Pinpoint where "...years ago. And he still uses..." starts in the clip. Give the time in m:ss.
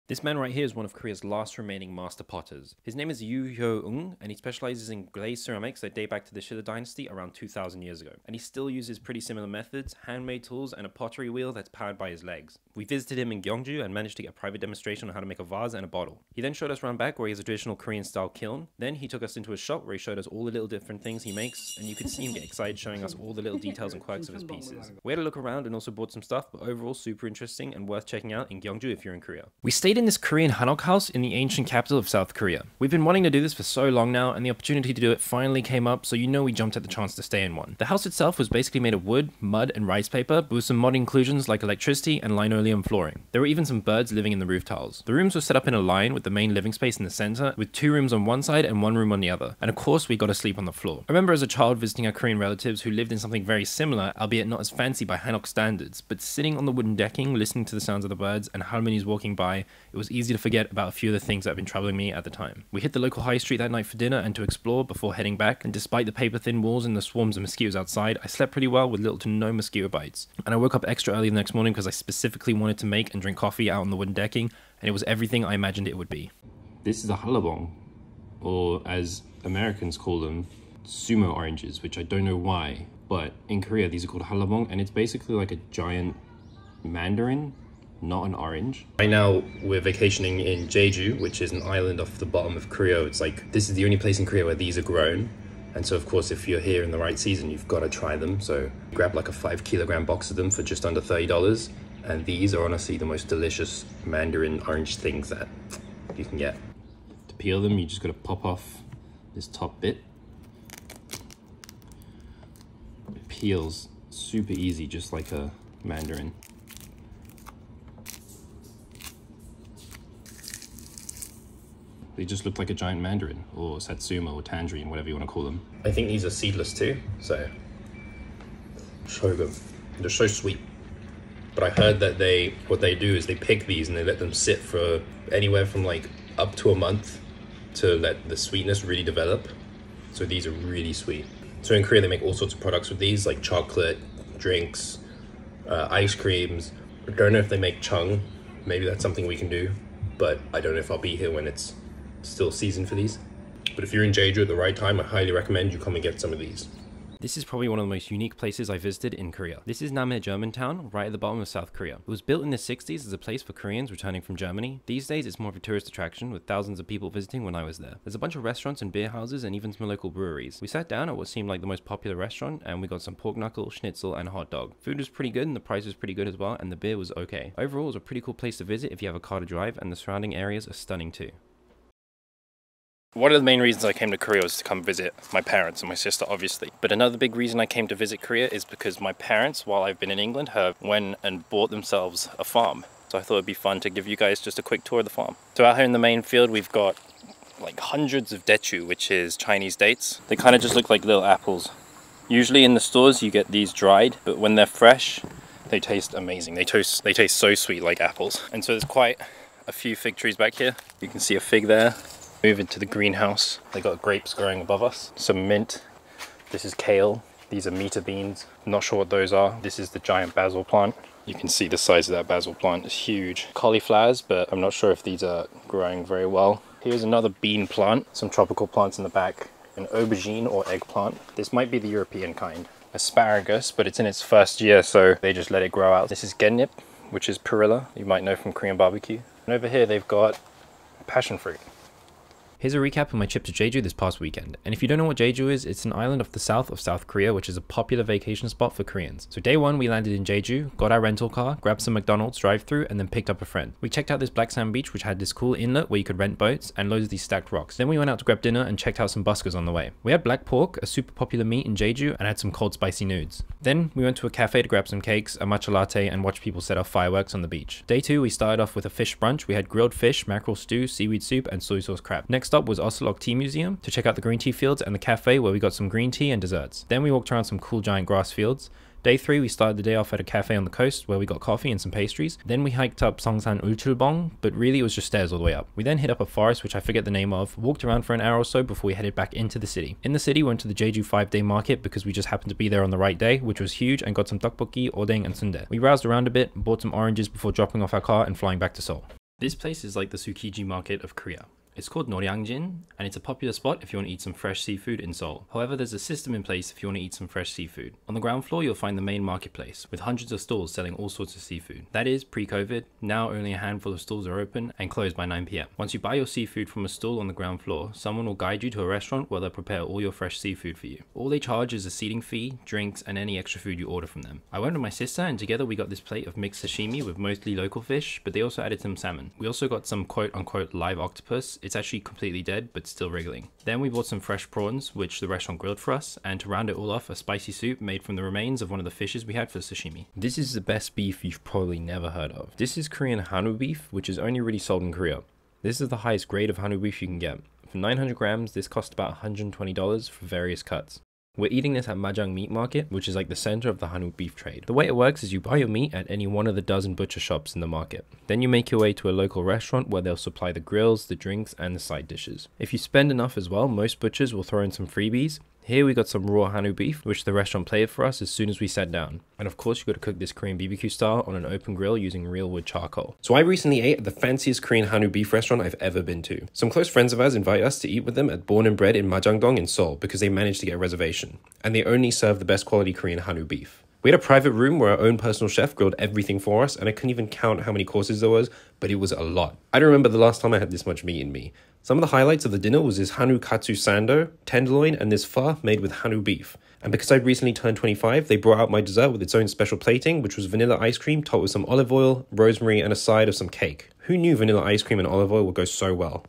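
0:07.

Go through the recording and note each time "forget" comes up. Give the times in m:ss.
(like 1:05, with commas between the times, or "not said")
1:00, 4:46.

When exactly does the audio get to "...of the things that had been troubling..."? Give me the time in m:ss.
1:01.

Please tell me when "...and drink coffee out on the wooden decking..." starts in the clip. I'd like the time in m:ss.
1:13.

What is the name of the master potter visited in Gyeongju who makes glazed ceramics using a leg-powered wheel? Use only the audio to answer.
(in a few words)
Yu Hyo Ung.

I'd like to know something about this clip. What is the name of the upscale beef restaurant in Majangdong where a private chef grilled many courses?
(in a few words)
Born and Bred.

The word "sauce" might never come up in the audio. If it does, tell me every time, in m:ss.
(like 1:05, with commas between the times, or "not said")
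4:31.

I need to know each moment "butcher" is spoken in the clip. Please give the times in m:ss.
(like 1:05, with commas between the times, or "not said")
5:56, 6:04.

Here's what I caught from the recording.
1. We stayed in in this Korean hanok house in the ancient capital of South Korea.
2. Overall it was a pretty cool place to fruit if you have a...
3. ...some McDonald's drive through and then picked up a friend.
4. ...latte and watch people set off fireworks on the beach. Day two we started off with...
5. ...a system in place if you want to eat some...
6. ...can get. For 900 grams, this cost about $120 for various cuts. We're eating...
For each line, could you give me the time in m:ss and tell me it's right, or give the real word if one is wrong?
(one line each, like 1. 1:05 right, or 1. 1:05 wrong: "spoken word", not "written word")
1. 0:29 right
2. 2:57 wrong: "visit", not "fruit"
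3. 4:11 right
4. 4:25 right
5. 5:05 right
6. 5:47 right.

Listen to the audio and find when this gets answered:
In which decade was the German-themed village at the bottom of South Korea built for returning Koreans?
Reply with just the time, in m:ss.
2:42.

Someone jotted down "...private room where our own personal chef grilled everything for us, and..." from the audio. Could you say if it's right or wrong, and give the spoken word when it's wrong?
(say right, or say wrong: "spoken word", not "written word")
right.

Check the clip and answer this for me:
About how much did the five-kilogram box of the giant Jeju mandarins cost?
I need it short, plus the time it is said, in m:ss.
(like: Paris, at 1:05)
just under $30, at 1:40.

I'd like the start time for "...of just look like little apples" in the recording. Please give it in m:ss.
3:20.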